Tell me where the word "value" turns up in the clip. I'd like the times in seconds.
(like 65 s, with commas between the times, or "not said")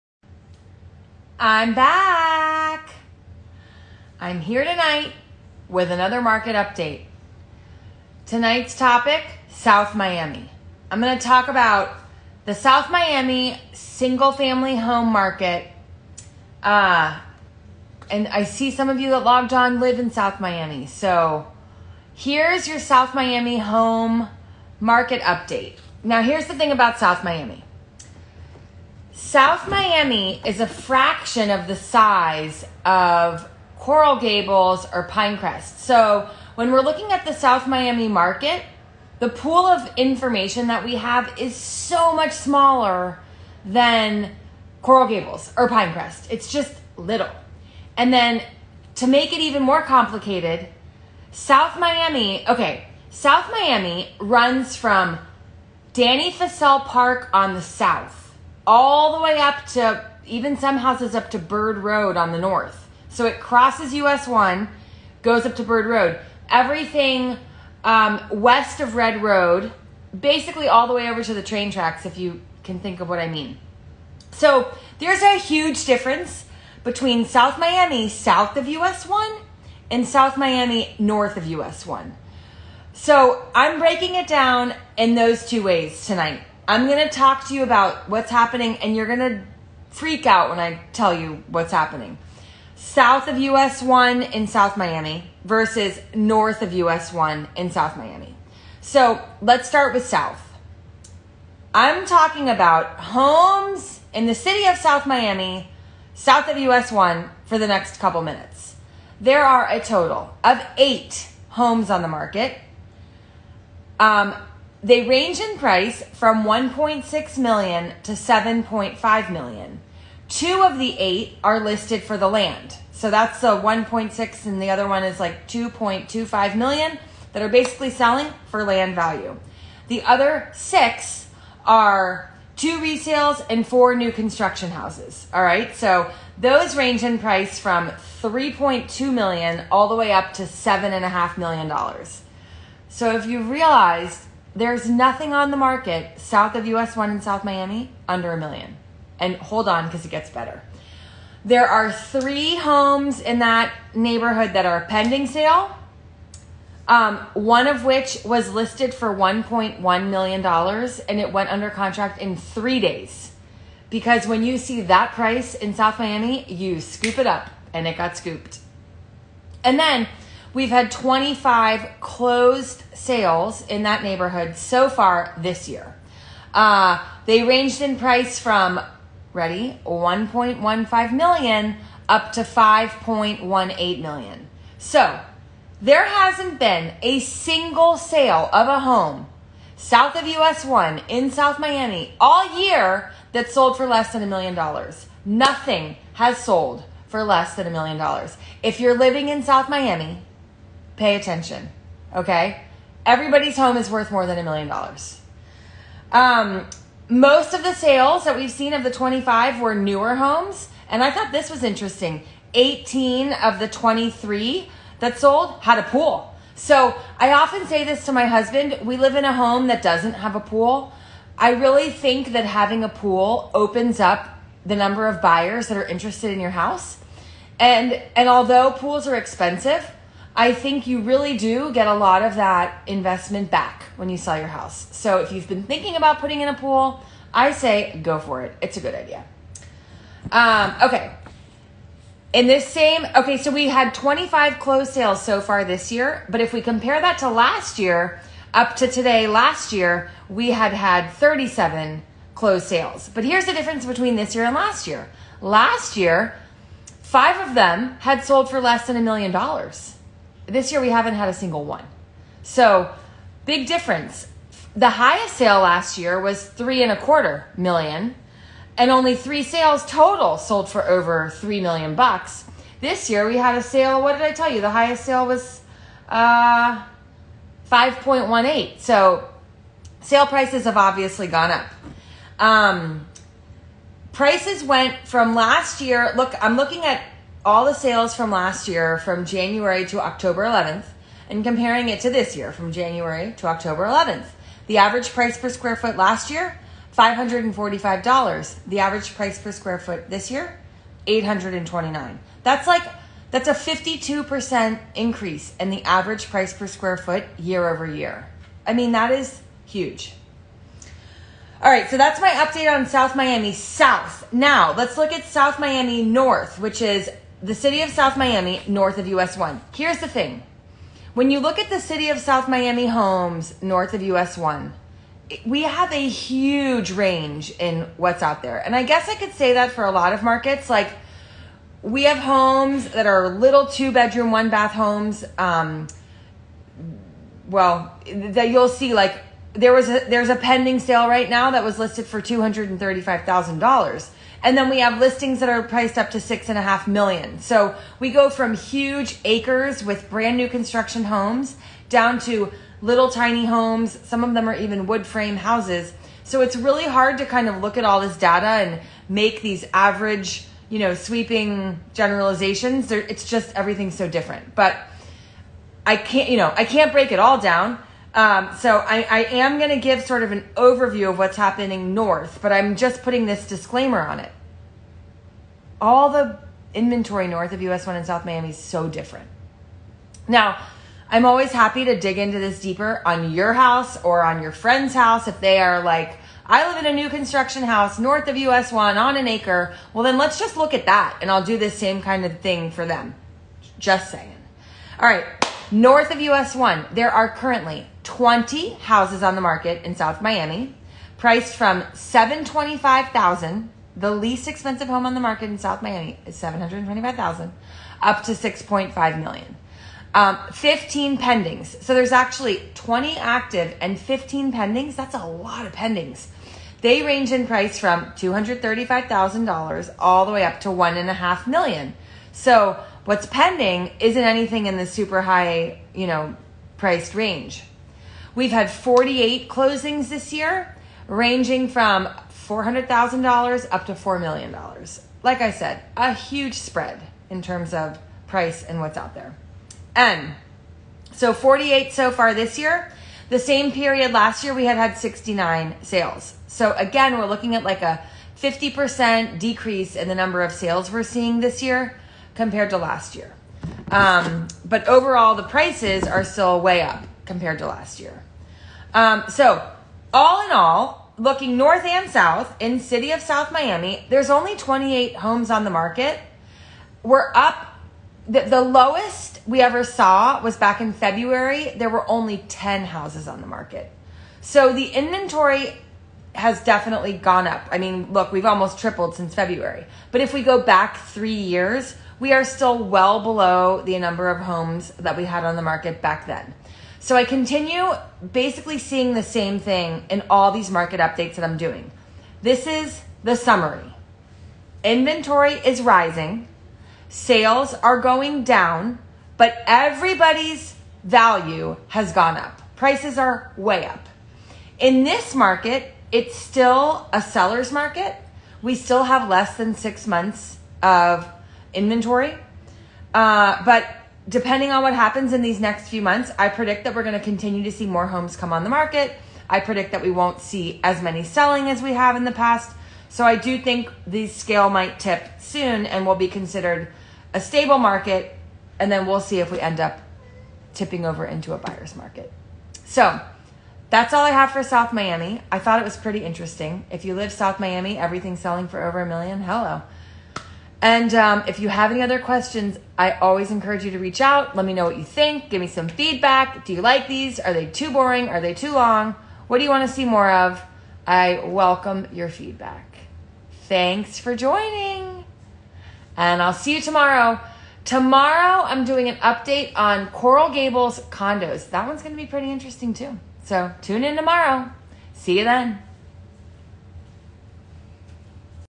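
128 s, 501 s.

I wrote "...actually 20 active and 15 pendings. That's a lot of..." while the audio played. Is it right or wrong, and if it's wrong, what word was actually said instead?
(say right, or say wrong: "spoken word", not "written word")
right.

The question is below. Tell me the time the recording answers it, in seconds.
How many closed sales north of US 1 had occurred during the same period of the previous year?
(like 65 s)
444 s.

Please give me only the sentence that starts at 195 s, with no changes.
Nothing has sold for less than a million dollars.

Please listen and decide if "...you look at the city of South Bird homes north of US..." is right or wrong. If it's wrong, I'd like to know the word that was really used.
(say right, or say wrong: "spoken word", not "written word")
wrong: "Miami", not "Bird".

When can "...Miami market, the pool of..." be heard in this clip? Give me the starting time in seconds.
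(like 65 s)
37 s.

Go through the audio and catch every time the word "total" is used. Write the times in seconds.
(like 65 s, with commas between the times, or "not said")
109 s, 269 s.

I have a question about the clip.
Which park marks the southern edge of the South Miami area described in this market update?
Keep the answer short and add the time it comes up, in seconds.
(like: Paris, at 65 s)
Dante Fascell Park, at 55 s.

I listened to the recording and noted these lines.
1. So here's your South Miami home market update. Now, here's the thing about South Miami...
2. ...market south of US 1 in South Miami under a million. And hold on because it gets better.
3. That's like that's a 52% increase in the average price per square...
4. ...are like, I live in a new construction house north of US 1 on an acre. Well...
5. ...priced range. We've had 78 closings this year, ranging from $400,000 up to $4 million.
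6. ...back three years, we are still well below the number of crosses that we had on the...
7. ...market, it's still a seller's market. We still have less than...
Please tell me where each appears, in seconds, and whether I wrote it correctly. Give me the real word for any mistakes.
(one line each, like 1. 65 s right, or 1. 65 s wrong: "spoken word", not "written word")
1. 20 s right
2. 145 s right
3. 302 s right
4. 385 s right
5. 426 s wrong: "48", not "78"
6. 480 s wrong: "homes", not "crosses"
7. 505 s right.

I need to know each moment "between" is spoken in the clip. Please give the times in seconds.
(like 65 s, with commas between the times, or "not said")
76 s, 253 s.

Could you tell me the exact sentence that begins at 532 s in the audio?
So that's all I have for South Miami.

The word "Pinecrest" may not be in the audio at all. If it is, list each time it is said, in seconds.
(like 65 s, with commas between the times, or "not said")
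35 s, 45 s.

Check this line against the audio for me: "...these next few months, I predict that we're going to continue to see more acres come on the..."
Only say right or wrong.
wrong.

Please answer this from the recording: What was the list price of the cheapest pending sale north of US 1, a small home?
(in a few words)
$235,000.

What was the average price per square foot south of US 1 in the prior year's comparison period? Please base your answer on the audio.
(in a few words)
$545.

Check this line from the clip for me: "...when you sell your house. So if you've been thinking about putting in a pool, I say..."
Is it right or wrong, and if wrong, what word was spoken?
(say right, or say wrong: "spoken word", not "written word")
right.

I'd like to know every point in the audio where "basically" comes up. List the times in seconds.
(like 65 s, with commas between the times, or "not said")
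70 s, 127 s, 488 s.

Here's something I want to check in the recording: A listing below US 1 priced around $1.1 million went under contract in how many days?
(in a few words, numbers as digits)
3.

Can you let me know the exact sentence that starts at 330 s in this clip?
Like, we have homes that are little two bedroom, one bath homes.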